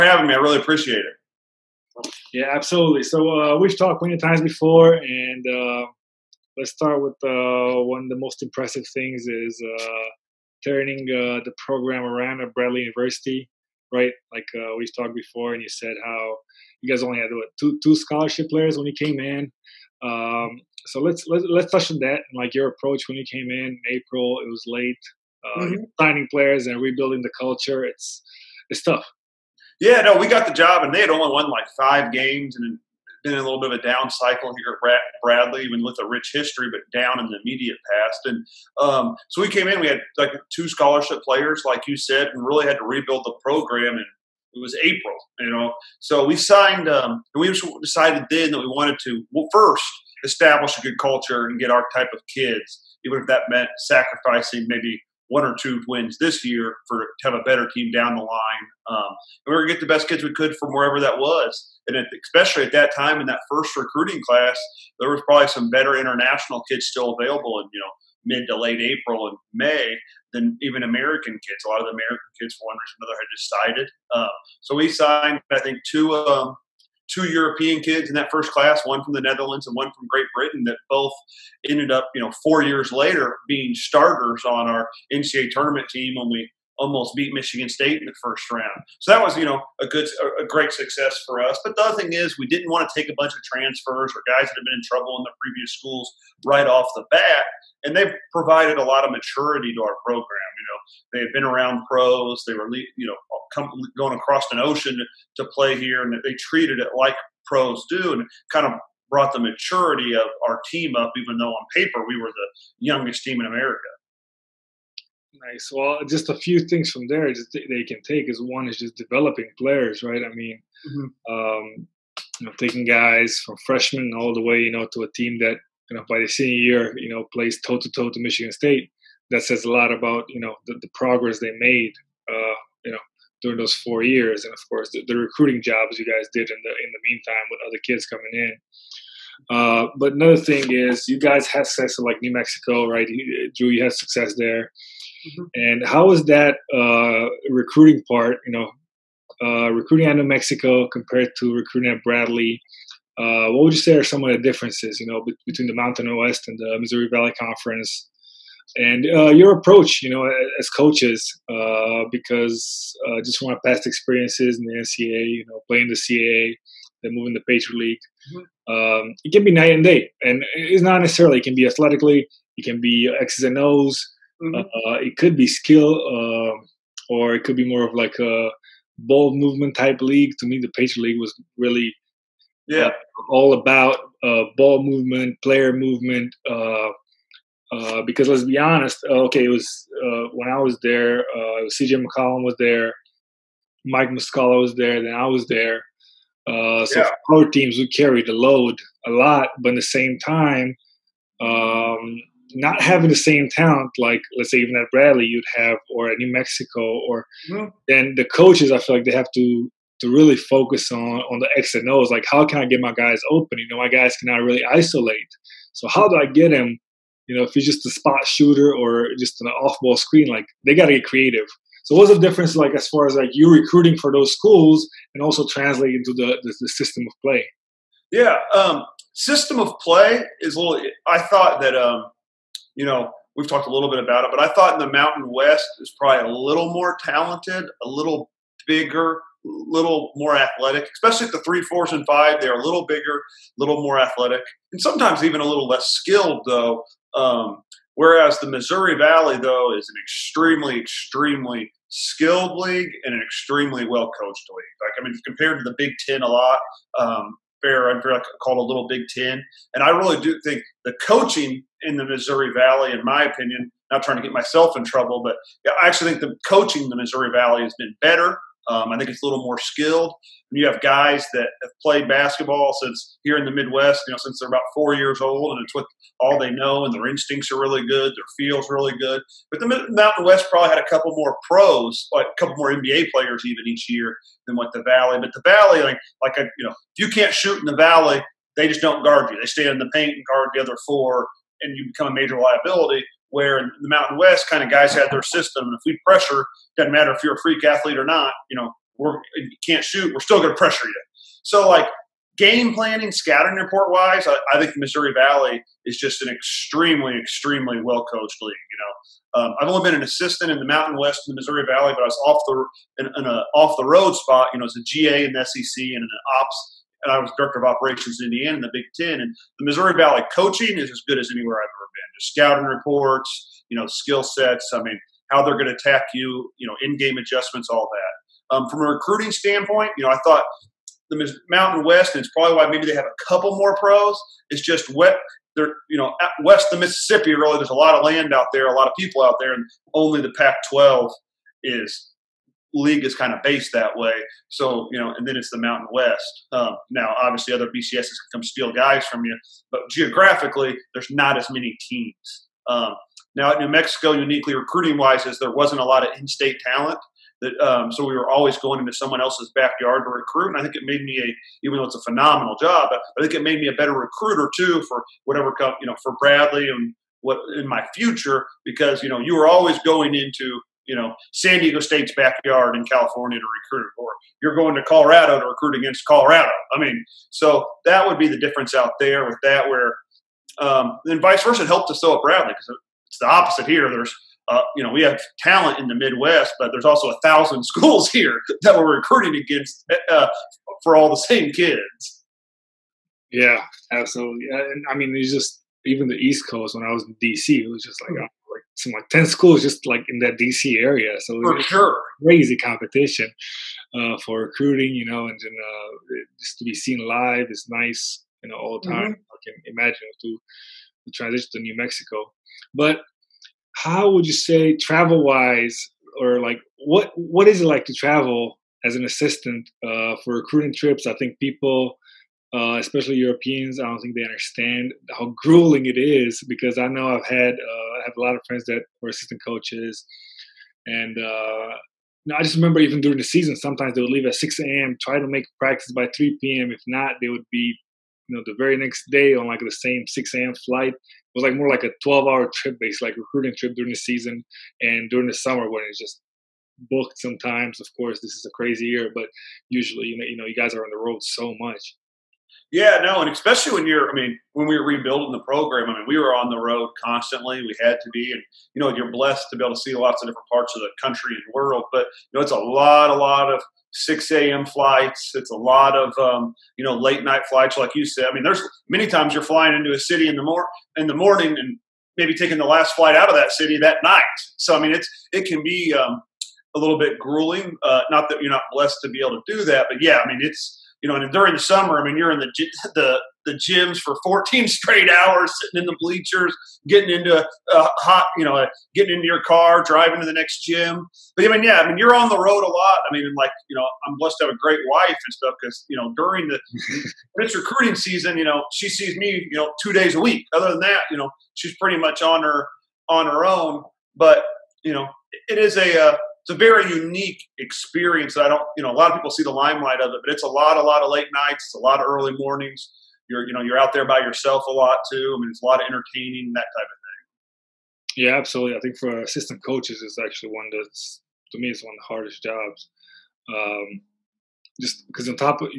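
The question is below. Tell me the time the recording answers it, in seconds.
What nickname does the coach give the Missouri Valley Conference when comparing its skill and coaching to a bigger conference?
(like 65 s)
258 s.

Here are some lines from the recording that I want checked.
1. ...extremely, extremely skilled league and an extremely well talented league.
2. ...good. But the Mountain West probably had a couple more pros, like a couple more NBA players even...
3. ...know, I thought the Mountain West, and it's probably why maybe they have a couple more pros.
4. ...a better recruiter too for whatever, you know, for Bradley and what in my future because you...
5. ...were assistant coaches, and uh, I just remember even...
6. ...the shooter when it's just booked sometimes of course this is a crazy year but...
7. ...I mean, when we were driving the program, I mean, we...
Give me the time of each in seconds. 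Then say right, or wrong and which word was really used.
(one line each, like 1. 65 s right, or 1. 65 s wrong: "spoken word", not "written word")
1. 250 s wrong: "coached", not "talented"
2. 279 s right
3. 330 s right
4. 363 s right
5. 429 s right
6. 445 s wrong: "summer", not "shooter"
7. 454 s wrong: "rebuilding", not "driving".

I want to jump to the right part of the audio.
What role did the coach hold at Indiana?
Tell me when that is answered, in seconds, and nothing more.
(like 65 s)
317 s.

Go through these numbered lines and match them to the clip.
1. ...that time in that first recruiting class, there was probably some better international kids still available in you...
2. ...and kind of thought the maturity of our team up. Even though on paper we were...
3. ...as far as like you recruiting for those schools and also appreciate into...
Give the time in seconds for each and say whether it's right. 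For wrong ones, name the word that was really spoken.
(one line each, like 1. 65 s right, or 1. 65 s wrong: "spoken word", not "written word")
1. 62 s right
2. 108 s wrong: "brought", not "thought"
3. 222 s wrong: "translate", not "appreciate".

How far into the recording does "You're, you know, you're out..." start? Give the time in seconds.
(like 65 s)
513 s.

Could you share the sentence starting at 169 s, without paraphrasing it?
um, it can be night and day, and it's not necessarily.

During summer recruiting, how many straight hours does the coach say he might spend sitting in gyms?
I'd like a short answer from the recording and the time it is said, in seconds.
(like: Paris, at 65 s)
14, at 484 s.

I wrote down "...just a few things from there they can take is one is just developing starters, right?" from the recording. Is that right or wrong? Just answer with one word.
wrong.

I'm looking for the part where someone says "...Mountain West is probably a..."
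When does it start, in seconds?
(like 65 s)
234 s.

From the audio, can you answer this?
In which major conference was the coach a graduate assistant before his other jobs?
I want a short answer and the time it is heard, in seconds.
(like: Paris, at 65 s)
SEC, at 315 s.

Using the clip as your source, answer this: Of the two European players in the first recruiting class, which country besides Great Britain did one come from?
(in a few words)
Netherlands.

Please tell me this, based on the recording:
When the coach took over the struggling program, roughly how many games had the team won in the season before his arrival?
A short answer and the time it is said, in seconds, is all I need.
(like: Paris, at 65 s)
5, at 31 s.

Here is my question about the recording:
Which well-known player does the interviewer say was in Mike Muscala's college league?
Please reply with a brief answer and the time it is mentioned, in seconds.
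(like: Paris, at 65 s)
CJ McCollum, at 191 s.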